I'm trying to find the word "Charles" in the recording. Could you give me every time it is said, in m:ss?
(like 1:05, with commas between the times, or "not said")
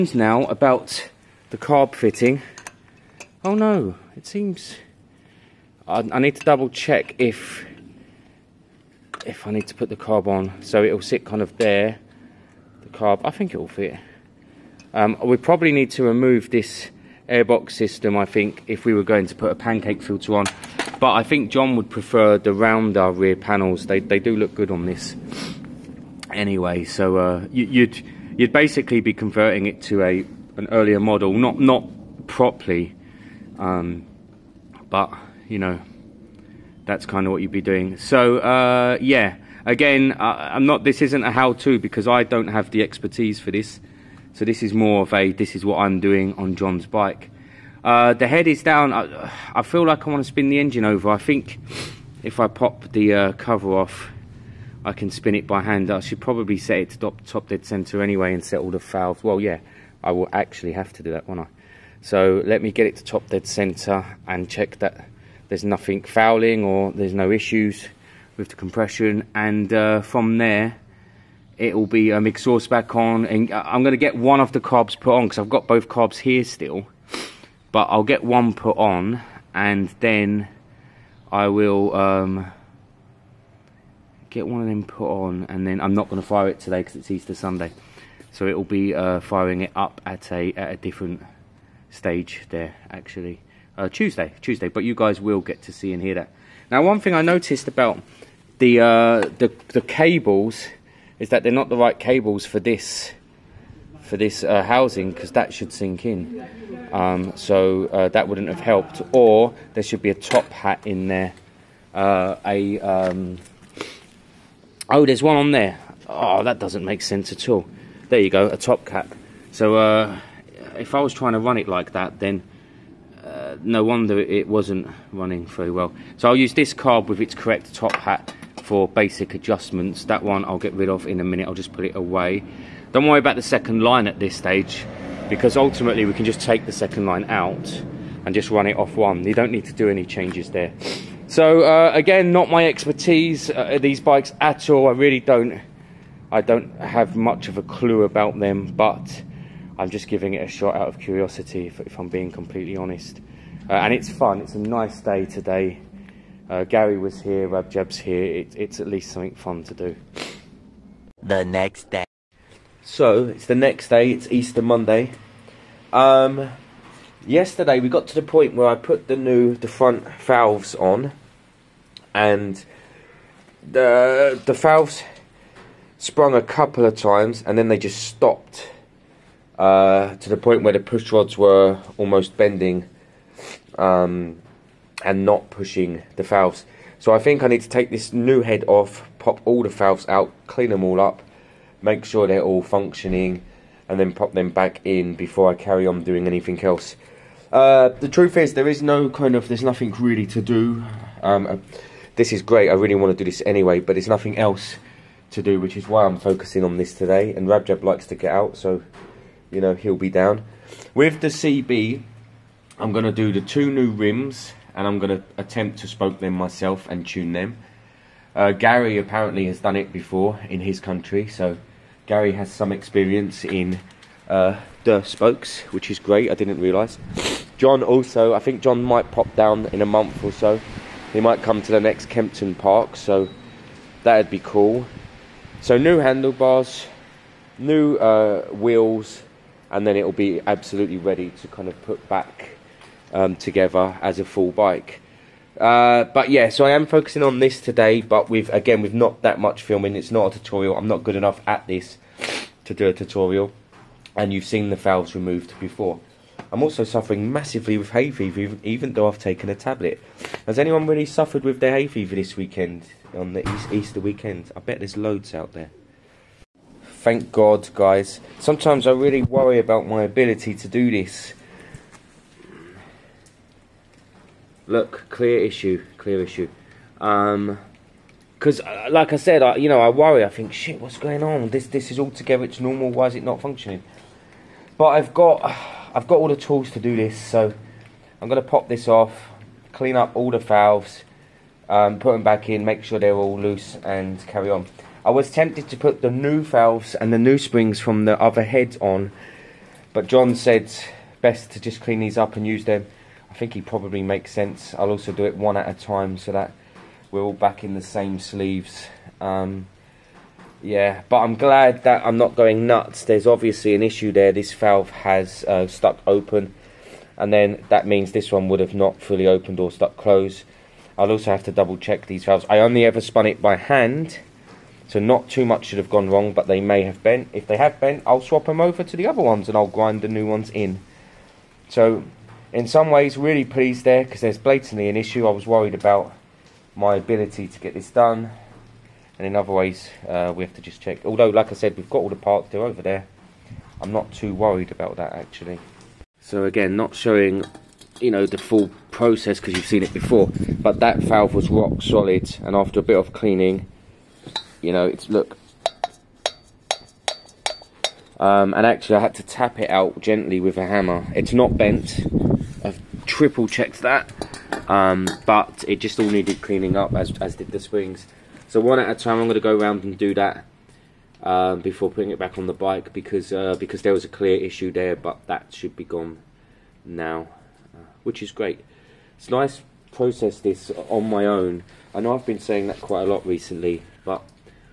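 not said.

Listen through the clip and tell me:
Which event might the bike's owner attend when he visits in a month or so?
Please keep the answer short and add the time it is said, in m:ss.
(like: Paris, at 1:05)
Kempton Park, at 3:52.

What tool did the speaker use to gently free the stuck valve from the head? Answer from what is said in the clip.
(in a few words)
hammer.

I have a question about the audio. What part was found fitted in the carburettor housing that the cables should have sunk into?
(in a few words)
top cap.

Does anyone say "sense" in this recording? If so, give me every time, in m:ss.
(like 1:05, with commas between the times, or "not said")
1:57, 5:04.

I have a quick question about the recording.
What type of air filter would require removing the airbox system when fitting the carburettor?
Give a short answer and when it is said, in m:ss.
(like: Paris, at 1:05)
pancake filter, at 0:19.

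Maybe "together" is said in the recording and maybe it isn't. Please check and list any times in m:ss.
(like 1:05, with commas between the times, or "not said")
4:03, 4:42.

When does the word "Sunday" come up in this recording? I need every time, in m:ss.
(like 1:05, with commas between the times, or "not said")
1:27.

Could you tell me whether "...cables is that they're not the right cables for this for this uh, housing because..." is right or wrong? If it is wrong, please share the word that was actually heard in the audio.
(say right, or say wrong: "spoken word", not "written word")
right.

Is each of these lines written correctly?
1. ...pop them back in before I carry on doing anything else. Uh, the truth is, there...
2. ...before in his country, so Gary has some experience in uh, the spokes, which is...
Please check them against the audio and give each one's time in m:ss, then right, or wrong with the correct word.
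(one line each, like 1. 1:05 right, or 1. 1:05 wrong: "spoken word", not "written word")
1. 3:14 right
2. 3:39 right.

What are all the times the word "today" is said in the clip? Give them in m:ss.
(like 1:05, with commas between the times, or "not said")
1:26, 2:35, 3:26, 4:07.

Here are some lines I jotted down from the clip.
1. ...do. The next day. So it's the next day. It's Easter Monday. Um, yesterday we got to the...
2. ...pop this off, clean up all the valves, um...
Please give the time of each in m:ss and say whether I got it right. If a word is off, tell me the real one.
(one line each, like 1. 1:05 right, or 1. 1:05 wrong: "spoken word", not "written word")
1. 2:39 right
2. 4:48 right.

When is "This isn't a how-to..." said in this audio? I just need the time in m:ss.
0:40.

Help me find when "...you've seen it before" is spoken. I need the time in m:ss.
5:49.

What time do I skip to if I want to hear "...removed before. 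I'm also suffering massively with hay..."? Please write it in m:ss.
4:15.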